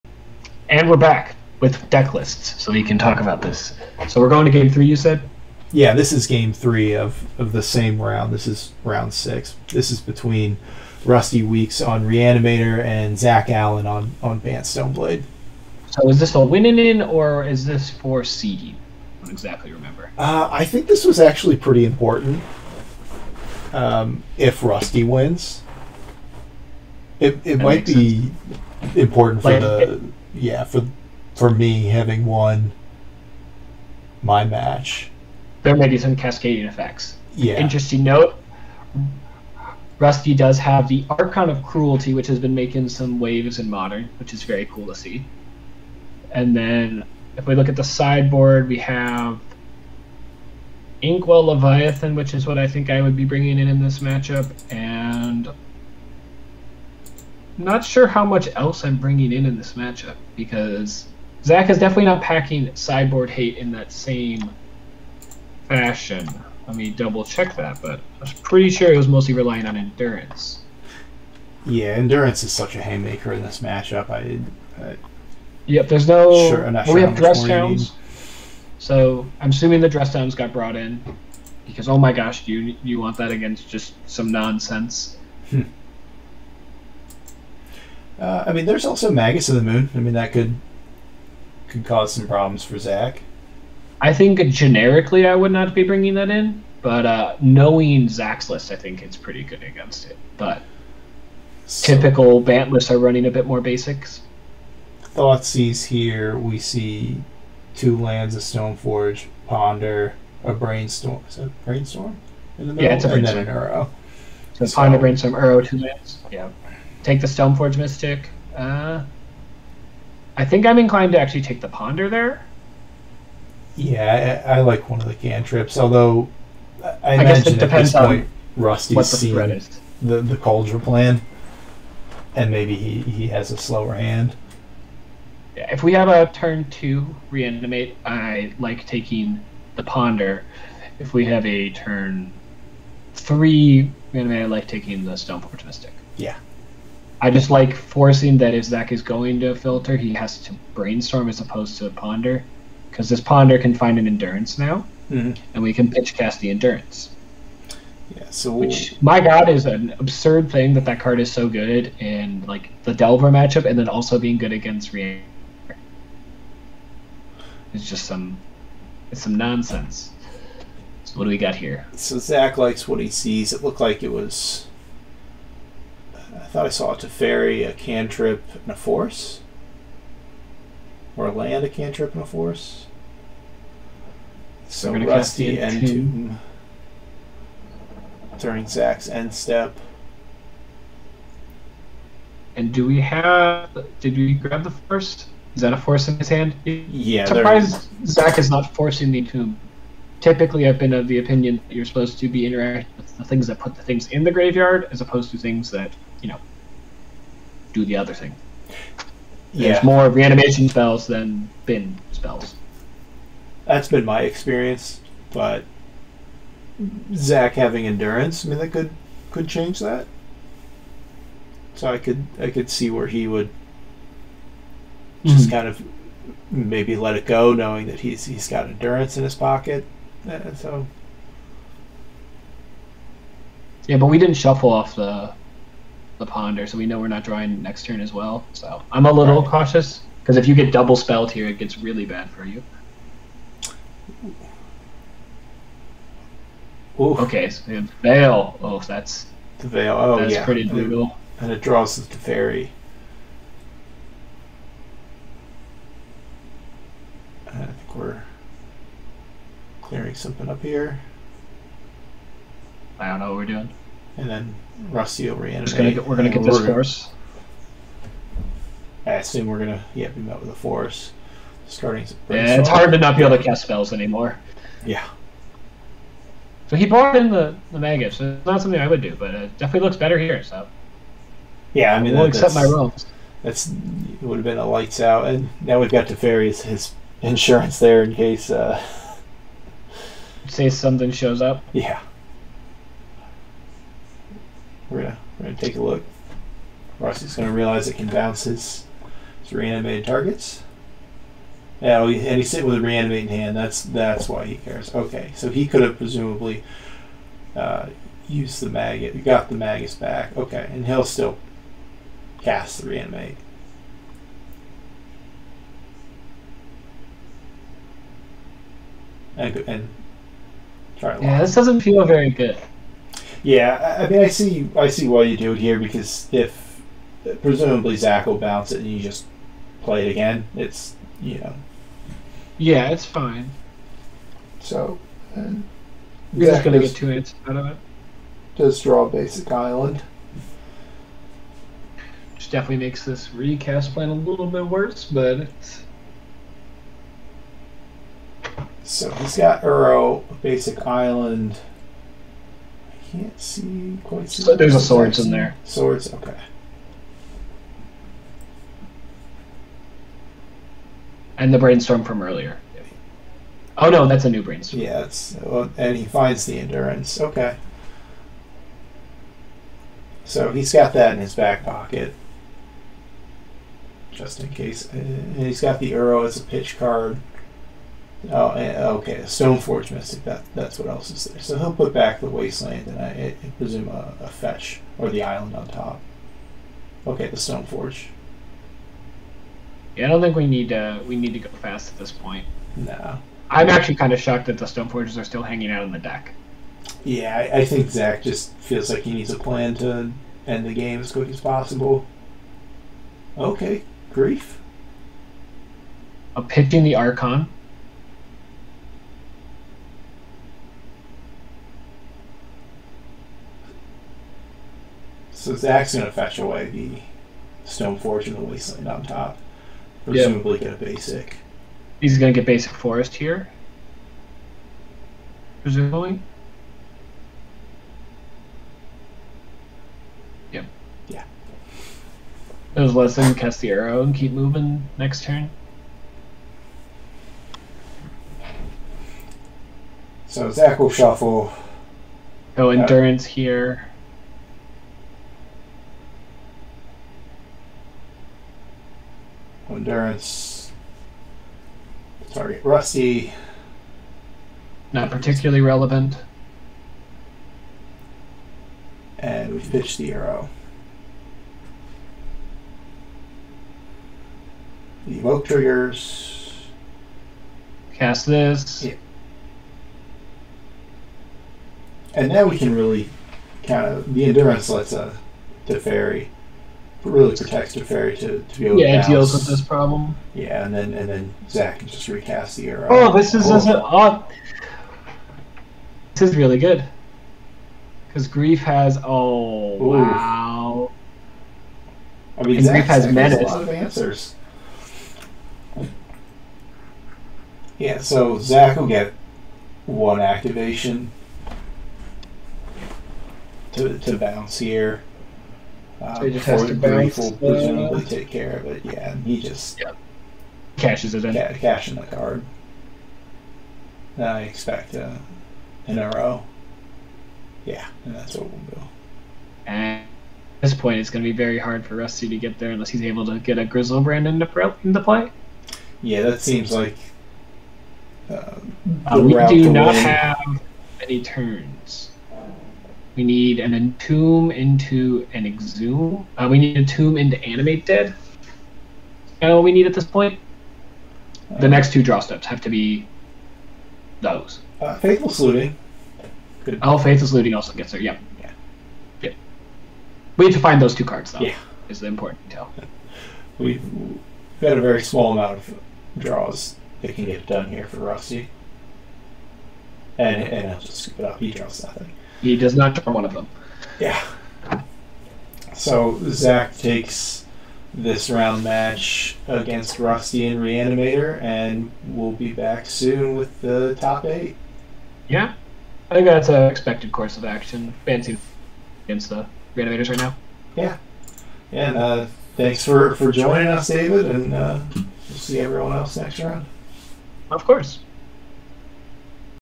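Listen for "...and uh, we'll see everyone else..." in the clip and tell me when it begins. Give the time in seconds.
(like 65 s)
584 s.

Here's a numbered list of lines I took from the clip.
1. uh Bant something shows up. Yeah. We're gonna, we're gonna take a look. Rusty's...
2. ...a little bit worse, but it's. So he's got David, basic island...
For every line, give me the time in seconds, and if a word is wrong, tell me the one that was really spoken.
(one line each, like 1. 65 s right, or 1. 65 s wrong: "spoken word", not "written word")
1. 288 s wrong: "Say", not "Bant"
2. 344 s wrong: "Uro", not "David".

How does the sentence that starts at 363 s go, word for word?
Oh no, that's a new brainstorm.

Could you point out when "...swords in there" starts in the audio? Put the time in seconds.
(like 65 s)
354 s.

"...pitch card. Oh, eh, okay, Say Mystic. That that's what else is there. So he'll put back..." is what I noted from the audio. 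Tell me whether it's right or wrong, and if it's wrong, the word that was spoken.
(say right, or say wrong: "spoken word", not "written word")
wrong: "Stoneforge", not "Say".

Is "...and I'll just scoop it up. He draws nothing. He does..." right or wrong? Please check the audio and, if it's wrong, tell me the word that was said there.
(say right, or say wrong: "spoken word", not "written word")
right.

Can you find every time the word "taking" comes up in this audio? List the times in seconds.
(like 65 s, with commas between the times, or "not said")
138 s, 144 s.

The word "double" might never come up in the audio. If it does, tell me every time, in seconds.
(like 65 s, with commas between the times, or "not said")
66 s, 240 s.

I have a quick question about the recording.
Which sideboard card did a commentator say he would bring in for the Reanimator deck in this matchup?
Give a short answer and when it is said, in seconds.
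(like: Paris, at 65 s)
Inkwell Leviathan, at 51 s.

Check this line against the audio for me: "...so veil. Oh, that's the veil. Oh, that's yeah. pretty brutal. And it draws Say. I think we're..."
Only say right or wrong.
wrong.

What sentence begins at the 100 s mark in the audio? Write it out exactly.
But so, typical Bant lists are running a bit more basics.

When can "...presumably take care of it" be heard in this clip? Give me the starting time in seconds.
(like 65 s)
507 s.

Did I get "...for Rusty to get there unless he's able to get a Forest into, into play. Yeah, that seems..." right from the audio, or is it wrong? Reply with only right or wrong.
wrong.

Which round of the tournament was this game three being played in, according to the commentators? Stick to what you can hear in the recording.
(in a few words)
6.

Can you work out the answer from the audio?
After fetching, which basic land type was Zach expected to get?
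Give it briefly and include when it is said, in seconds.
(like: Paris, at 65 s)
Forest, at 422 s.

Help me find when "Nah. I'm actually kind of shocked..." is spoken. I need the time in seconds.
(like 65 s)
392 s.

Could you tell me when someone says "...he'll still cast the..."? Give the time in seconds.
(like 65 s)
310 s.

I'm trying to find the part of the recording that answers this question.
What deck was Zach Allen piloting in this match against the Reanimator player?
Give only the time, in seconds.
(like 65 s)
14 s.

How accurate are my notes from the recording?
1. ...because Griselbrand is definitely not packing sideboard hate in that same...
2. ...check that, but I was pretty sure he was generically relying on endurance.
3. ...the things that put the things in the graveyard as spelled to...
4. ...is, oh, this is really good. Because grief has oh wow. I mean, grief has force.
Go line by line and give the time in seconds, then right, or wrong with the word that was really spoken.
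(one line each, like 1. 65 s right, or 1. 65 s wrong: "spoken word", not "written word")
1. 60 s wrong: "Zach", not "Griselbrand"
2. 67 s wrong: "mostly", not "generically"
3. 203 s wrong: "opposed", not "spelled"
4. 483 s wrong: "menace", not "force".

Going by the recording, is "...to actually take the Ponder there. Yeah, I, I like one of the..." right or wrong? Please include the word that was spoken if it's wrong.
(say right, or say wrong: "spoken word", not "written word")
right.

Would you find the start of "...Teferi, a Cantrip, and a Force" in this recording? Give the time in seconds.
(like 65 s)
176 s.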